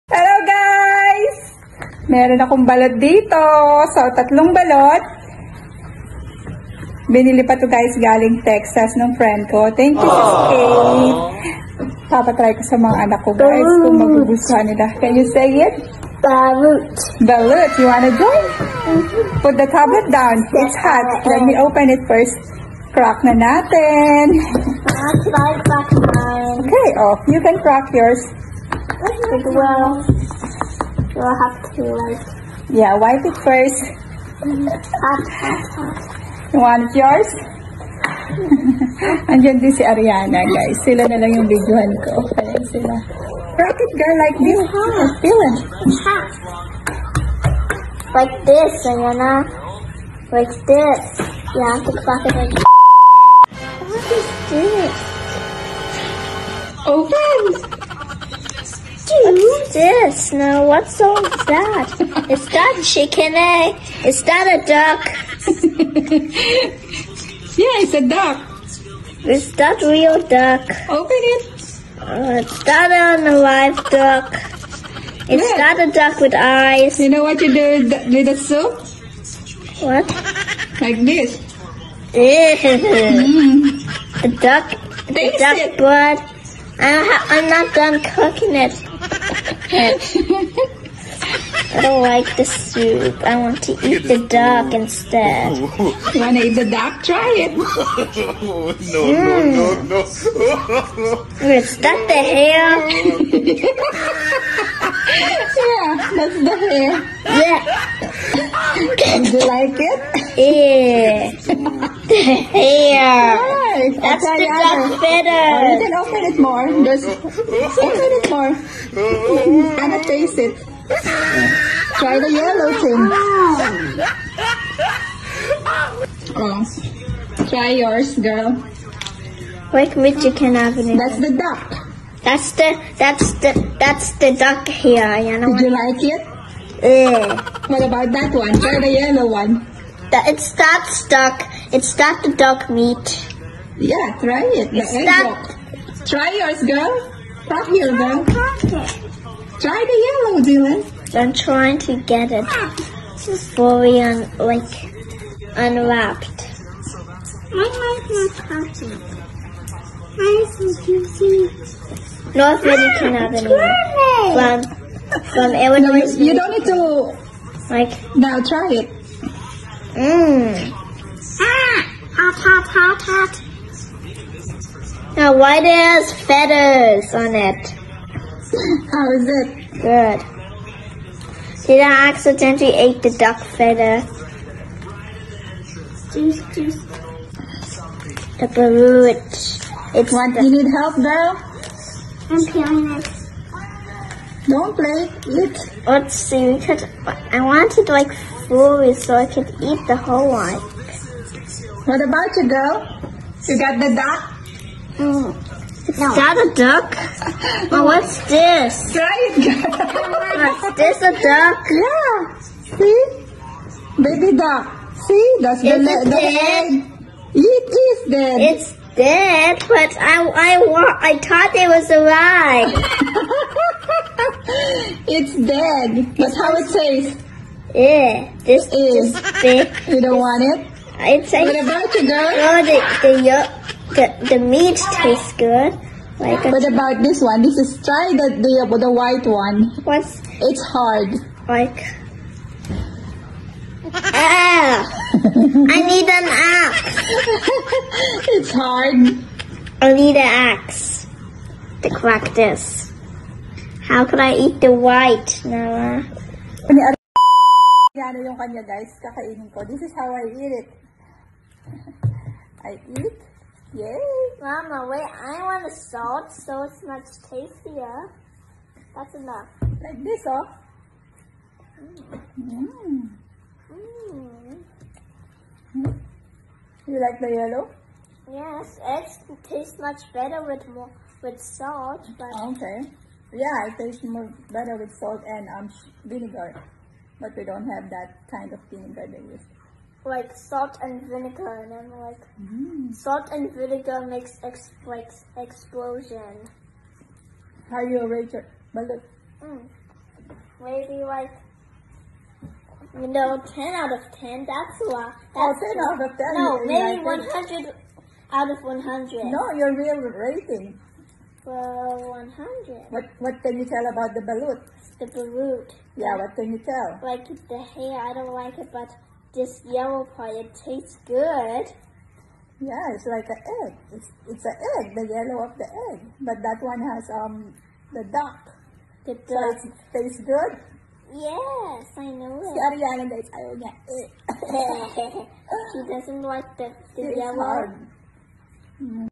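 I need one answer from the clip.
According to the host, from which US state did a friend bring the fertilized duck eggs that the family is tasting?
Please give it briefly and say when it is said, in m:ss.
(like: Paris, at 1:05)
Texas, at 0:08.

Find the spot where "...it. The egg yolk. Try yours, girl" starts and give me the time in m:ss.
2:24.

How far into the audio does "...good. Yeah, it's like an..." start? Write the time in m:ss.
5:21.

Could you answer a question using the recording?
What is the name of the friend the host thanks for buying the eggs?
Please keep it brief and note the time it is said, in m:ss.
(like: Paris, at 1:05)
Kate, at 0:10.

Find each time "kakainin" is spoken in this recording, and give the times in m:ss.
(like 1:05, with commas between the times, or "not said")
4:19.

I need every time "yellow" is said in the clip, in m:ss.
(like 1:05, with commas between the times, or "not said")
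2:02, 2:18, 2:30, 4:37, 5:19, 5:25, 5:37.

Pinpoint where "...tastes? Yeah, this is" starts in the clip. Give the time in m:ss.
3:46.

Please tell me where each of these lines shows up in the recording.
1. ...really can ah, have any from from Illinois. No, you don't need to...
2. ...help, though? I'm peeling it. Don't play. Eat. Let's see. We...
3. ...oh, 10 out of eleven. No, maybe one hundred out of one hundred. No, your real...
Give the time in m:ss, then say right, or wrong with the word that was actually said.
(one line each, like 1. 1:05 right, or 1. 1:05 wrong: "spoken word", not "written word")
1. 2:42 right
2. 3:10 right
3. 5:05 wrong: "ten", not "eleven".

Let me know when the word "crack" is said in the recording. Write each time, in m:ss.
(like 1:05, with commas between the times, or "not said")
0:22, 0:27, 4:11.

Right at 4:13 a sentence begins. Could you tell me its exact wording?
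How could I eat the white, Noah?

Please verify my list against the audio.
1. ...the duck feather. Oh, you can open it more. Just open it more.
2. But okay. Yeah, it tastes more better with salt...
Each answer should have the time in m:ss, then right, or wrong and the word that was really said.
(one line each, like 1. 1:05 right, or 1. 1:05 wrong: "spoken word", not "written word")
1. 1:54 wrong: "better", not "feather"
2. 4:42 right.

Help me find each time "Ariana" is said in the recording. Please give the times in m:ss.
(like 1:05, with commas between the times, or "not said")
0:39, 0:48, 5:32.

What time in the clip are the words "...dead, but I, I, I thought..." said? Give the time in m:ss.
3:38.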